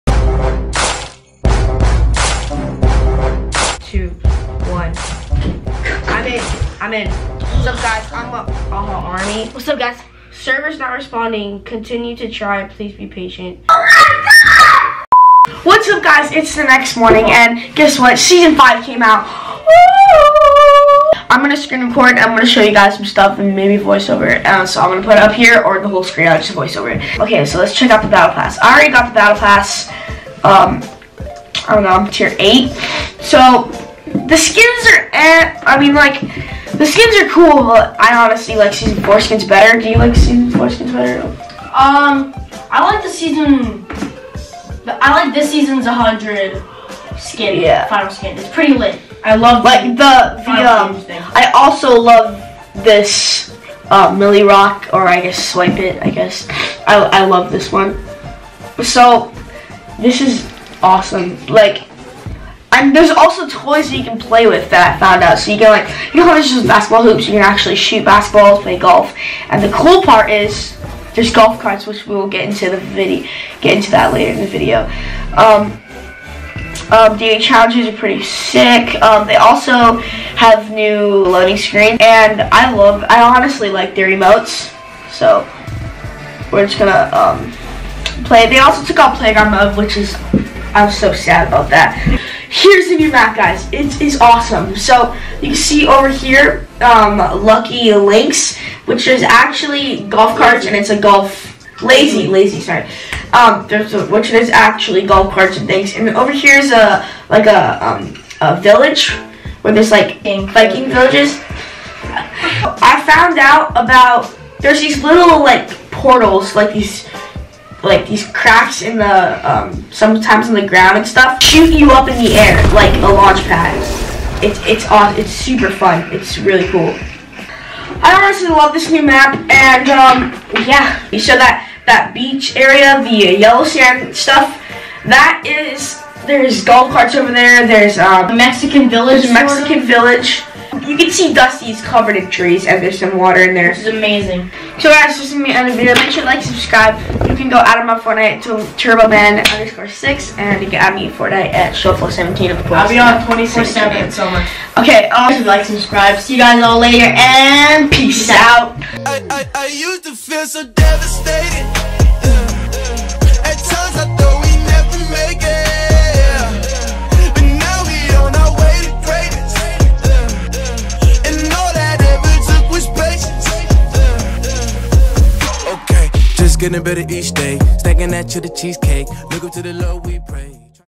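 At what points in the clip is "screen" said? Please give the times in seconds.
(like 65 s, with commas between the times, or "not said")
21 s, 26 s, 81 s.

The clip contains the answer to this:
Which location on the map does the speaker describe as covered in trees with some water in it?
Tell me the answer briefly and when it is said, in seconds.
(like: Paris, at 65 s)
Dusty, at 141 s.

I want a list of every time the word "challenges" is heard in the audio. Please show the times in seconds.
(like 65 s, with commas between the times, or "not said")
77 s.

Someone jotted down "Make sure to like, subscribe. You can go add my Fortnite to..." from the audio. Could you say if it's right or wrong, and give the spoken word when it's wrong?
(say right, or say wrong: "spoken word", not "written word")
right.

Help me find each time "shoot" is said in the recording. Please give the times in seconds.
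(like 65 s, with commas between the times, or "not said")
67 s, 121 s.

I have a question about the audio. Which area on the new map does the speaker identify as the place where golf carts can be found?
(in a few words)
Lucky Links.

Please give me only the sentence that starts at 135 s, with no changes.
That is there's golf carts over there.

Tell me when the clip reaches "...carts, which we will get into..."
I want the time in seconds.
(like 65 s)
71 s.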